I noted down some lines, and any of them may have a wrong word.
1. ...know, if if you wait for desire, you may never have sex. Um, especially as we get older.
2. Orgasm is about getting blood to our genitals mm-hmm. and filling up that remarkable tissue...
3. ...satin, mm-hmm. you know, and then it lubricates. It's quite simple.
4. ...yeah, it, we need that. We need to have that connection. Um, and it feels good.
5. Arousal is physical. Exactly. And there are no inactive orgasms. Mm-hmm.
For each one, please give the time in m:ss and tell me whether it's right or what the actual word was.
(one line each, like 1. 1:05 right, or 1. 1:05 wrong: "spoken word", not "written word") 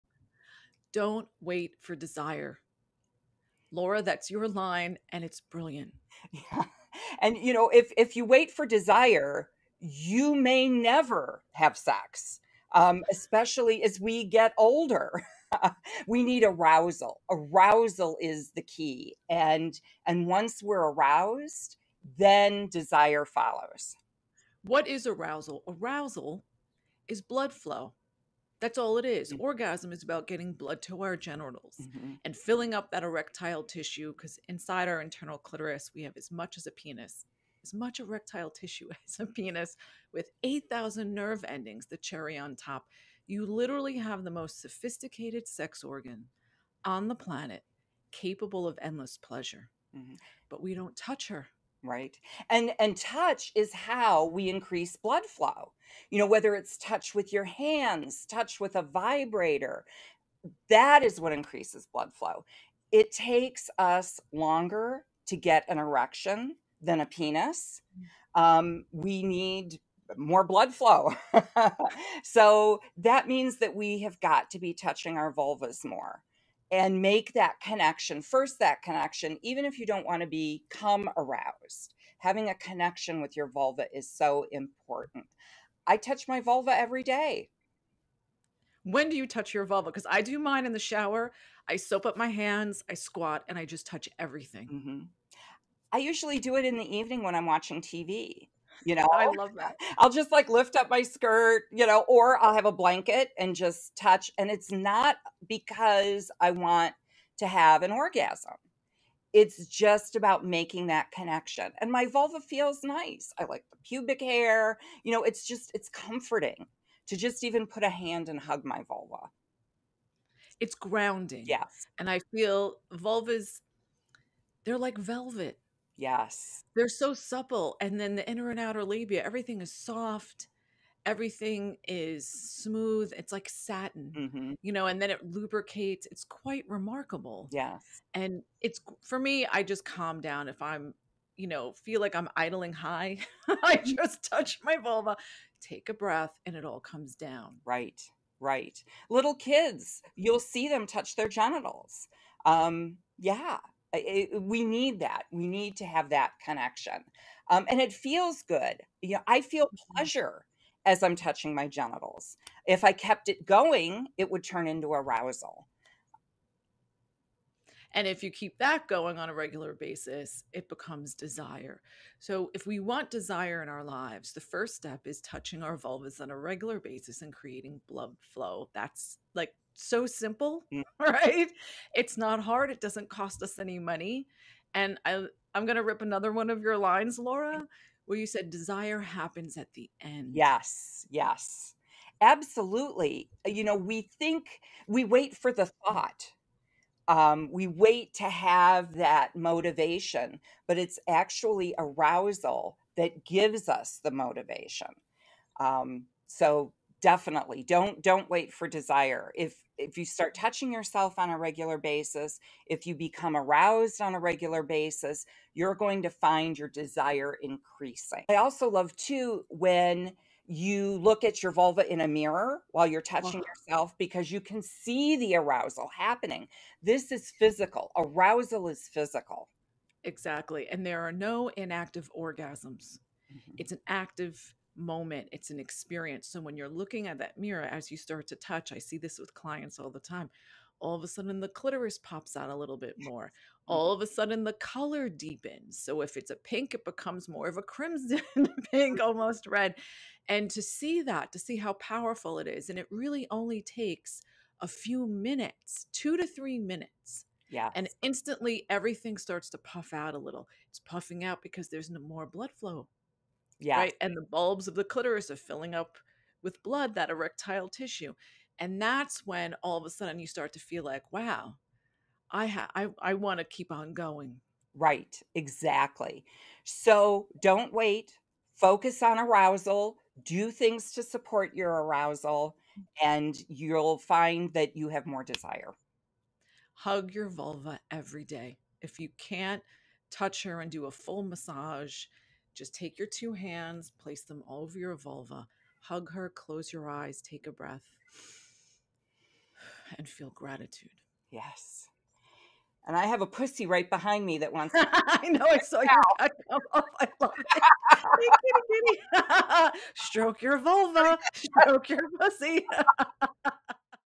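1. 0:07 right
2. 0:29 wrong: "erectile", not "remarkable"
3. 2:13 wrong: "remarkable", not "simple"
4. 2:33 right
5. 3:47 right.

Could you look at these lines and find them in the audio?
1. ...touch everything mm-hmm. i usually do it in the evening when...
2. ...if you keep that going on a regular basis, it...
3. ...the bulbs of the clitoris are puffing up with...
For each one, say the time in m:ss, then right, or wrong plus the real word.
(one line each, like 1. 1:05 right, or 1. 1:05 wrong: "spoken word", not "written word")
1. 1:33 right
2. 2:48 right
3. 4:24 wrong: "filling", not "puffing".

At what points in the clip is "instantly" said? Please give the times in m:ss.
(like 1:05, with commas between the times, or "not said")
4:18.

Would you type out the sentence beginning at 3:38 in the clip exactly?
I also love too when you look at your vulva in a mirror while you're touching wow.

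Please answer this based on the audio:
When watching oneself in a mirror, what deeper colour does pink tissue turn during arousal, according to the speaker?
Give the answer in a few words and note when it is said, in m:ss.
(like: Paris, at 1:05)
crimson, at 4:07.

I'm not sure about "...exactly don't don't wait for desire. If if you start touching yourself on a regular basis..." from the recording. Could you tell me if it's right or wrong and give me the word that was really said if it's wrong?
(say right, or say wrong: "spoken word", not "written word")
wrong: "definitely", not "exactly".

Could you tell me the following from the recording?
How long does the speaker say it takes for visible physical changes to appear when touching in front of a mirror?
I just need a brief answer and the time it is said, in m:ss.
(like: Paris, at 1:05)
2 to 3 minutes, at 4:15.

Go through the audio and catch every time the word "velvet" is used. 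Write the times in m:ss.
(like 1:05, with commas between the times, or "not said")
2:04.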